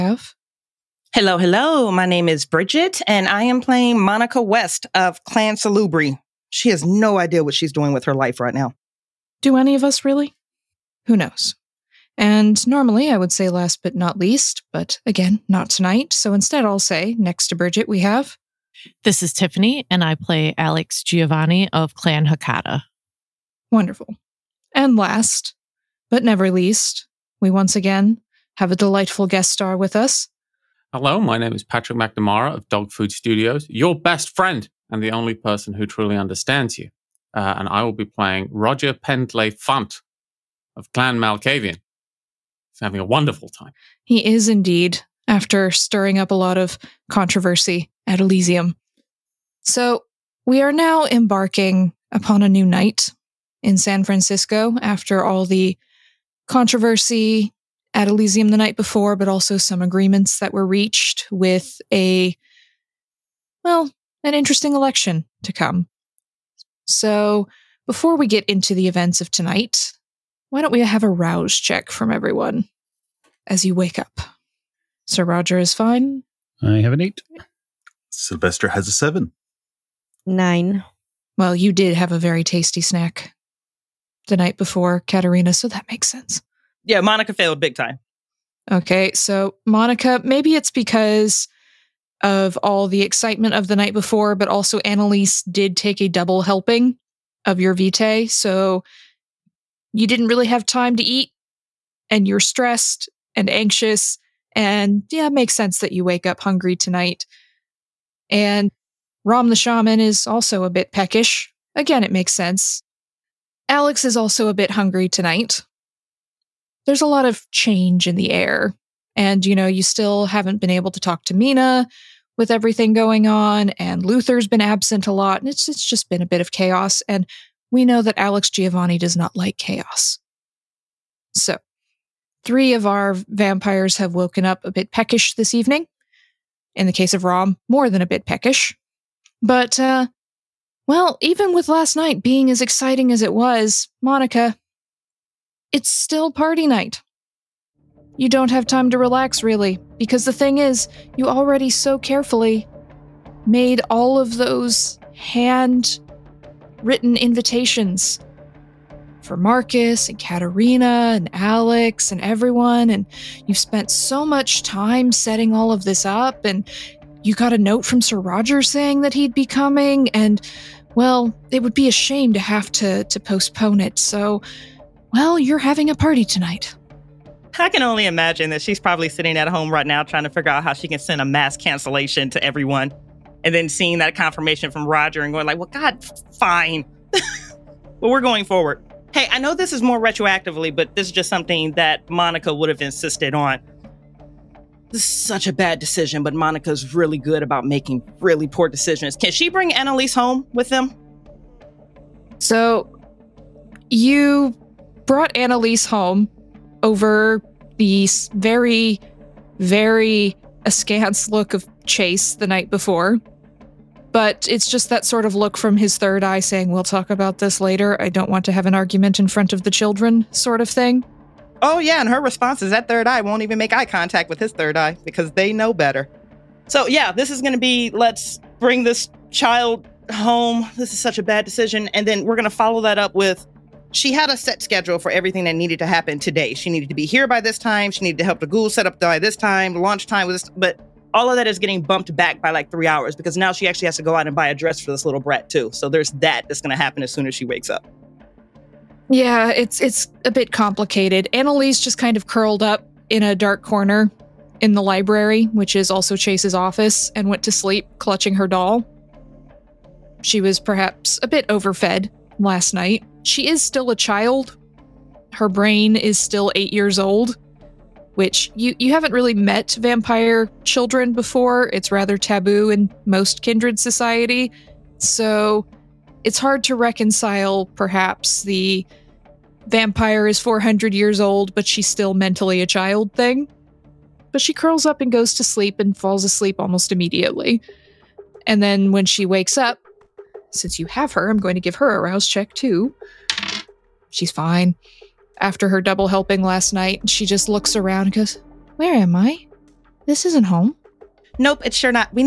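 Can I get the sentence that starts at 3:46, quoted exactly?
So, yeah, this is going to be let's bring this child home.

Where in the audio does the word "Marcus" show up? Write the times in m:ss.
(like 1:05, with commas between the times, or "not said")
2:39.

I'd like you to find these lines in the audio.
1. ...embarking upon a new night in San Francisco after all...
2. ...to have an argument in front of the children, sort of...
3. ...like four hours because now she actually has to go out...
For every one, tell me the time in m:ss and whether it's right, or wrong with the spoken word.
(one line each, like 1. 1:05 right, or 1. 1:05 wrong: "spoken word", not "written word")
1. 0:51 right
2. 3:38 right
3. 4:02 wrong: "three", not "four".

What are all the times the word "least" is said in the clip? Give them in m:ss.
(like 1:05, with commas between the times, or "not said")
0:14, 0:26.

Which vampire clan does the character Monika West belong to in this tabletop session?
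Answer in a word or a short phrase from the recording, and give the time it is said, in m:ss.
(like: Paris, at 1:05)
Salubri, at 0:05.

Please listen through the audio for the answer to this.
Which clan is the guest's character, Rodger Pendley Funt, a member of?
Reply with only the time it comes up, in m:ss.
0:40.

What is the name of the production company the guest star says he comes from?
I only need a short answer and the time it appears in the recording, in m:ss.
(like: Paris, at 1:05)
Dog Food Studios, at 0:32.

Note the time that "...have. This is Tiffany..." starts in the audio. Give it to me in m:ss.
0:17.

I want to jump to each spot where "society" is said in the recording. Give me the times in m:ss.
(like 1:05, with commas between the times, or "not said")
4:33.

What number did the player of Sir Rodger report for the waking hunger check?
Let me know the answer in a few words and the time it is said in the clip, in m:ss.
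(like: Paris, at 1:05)
8, at 1:16.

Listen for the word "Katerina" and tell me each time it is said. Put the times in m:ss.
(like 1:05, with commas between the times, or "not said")
1:25, 2:40.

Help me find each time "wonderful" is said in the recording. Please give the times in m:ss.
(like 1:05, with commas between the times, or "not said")
0:23, 0:43.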